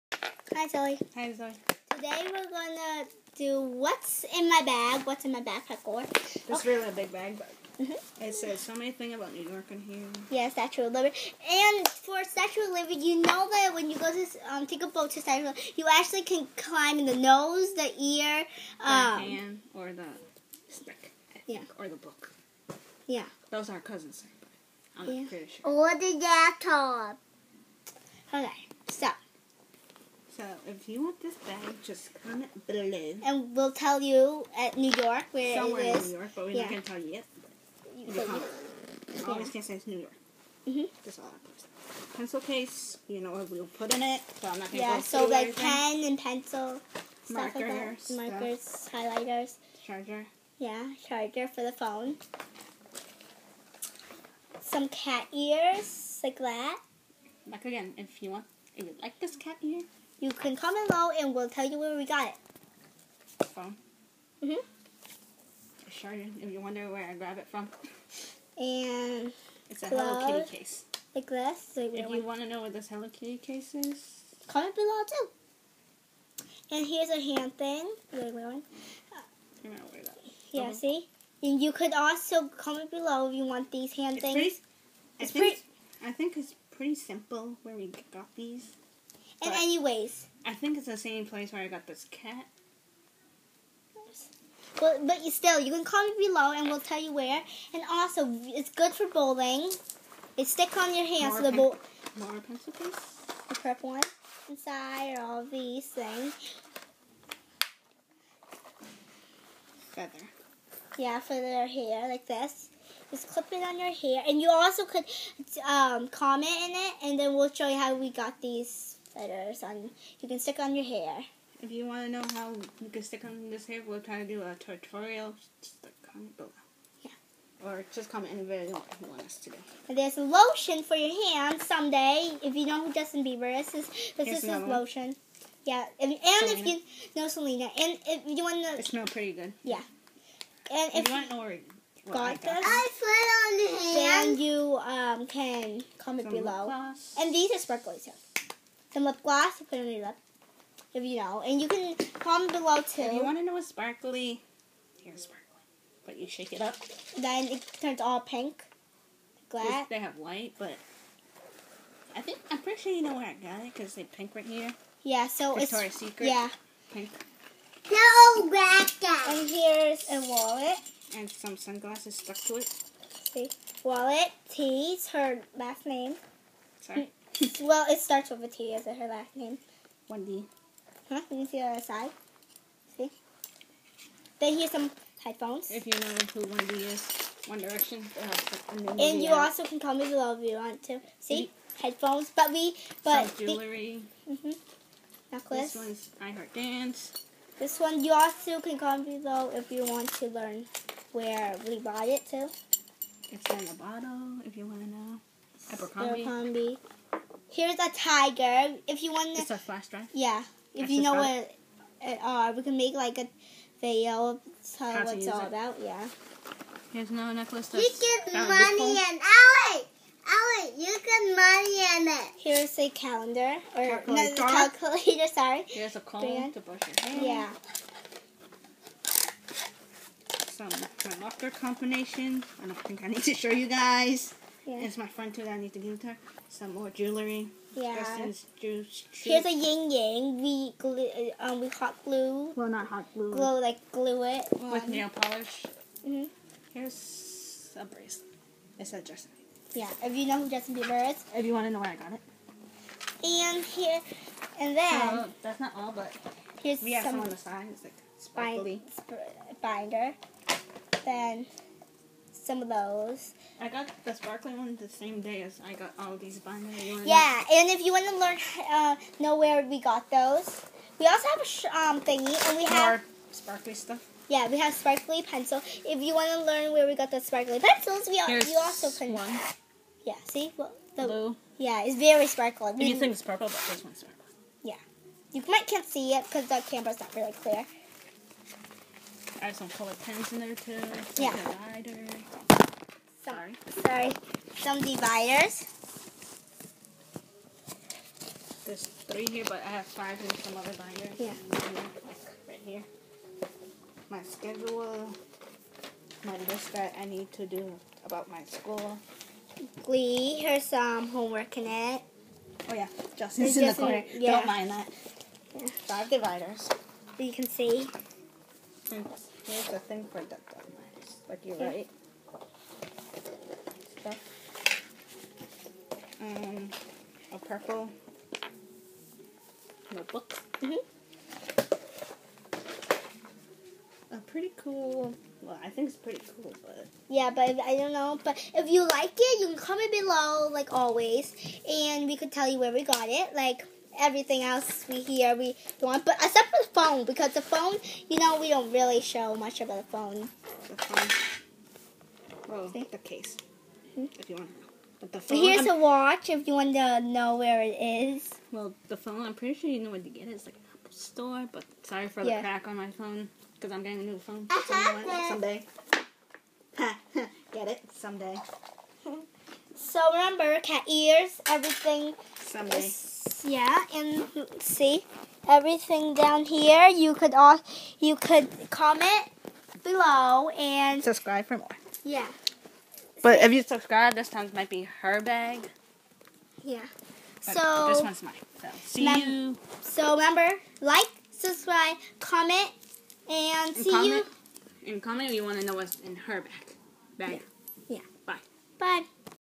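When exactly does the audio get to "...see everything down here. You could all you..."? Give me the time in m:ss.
6:14.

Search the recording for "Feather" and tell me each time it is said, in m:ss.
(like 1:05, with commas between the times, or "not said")
1:49.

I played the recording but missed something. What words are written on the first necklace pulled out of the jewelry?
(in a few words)
I Heart Dance.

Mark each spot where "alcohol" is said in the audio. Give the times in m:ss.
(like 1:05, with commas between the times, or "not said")
not said.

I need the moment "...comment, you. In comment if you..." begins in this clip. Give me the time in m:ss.
6:33.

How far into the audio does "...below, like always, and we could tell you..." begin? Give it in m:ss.
5:39.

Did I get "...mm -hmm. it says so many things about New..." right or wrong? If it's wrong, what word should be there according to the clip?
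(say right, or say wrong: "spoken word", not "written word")
right.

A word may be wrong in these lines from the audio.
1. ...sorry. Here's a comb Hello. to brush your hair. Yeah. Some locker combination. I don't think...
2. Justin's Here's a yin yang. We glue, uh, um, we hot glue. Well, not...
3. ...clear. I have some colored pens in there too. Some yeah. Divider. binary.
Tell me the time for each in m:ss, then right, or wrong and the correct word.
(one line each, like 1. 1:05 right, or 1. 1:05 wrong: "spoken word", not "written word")
1. 3:45 wrong: "Brand", not "Hello"
2. 3:57 right
3. 4:47 wrong: "sorry", not "binary".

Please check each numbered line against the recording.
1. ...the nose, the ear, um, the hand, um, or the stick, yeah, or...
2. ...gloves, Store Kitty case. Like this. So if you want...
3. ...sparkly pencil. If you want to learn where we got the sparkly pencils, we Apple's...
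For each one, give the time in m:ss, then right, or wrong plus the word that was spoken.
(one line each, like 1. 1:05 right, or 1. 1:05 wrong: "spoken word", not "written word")
1. 0:17 right
2. 1:09 wrong: "Hello", not "Store"
3. 4:34 wrong: "Here", not "Apple".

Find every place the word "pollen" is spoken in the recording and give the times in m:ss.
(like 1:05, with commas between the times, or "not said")
not said.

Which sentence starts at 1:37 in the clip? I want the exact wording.
And also, it's good for bowling.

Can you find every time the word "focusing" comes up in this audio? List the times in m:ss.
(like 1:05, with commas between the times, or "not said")
not said.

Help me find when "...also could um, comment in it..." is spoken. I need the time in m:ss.
1:54.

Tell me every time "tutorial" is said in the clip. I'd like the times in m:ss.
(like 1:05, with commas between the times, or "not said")
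2:04.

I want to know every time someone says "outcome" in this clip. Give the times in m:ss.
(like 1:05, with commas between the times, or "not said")
not said.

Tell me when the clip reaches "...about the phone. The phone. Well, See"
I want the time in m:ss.
5:49.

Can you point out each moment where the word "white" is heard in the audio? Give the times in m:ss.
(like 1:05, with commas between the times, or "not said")
2:40.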